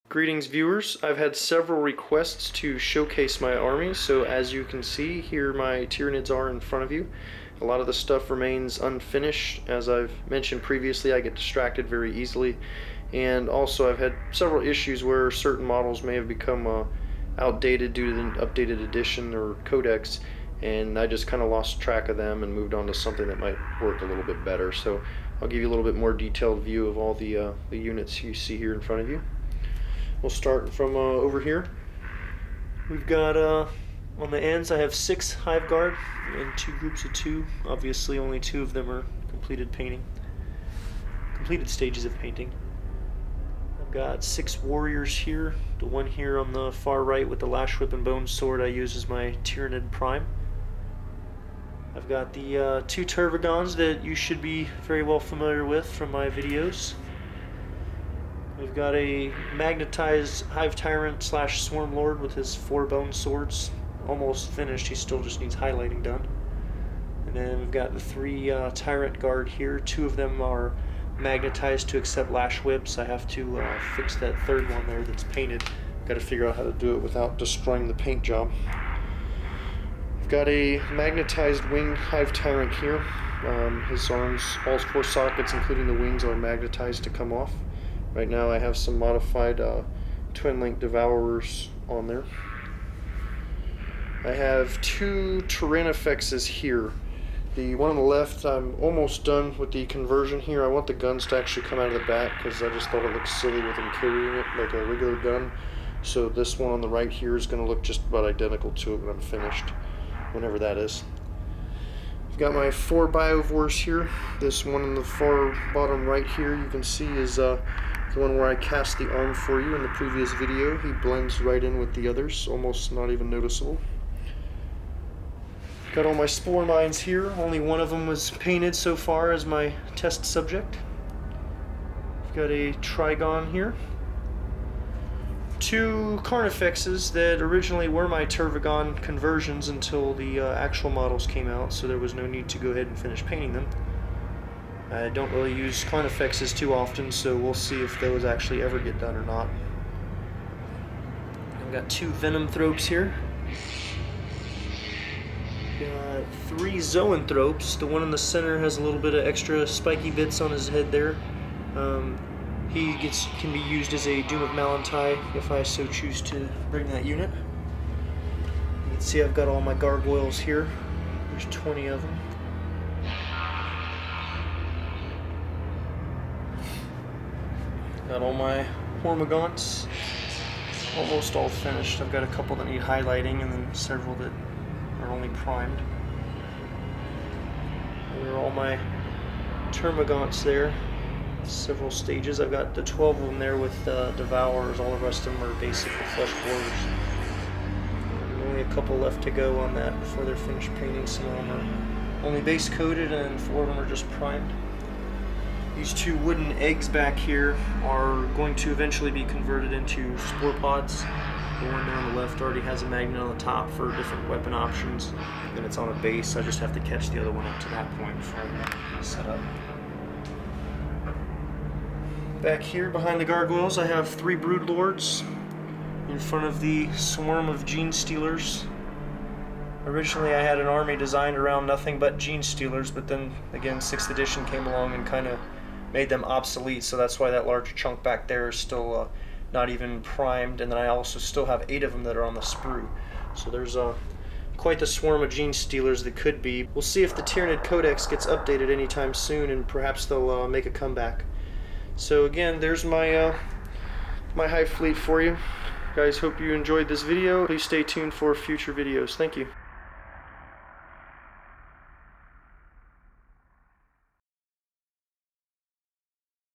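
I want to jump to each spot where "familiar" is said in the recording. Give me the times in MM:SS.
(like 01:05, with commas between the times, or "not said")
00:55.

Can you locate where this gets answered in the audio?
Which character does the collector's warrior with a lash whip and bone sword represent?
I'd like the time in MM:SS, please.
00:49.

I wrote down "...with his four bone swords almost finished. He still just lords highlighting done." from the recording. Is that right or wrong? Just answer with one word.
wrong.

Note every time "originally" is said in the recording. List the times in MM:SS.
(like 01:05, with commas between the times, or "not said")
02:17, 03:49.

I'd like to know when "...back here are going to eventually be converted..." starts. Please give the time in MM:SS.
03:26.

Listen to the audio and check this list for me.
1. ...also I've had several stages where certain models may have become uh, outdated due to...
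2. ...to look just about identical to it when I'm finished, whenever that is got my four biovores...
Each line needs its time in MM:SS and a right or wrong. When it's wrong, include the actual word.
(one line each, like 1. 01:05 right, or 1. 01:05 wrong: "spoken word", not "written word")
1. 00:13 wrong: "issues", not "stages"
2. 01:47 right.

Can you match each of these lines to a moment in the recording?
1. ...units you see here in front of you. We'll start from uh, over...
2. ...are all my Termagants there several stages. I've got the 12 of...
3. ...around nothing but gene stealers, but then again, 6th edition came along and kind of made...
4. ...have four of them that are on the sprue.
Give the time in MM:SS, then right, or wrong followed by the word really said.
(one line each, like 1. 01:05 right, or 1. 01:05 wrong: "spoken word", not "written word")
1. 00:27 right
2. 03:08 right
3. 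03:51 right
4. 04:01 wrong: "eight", not "four".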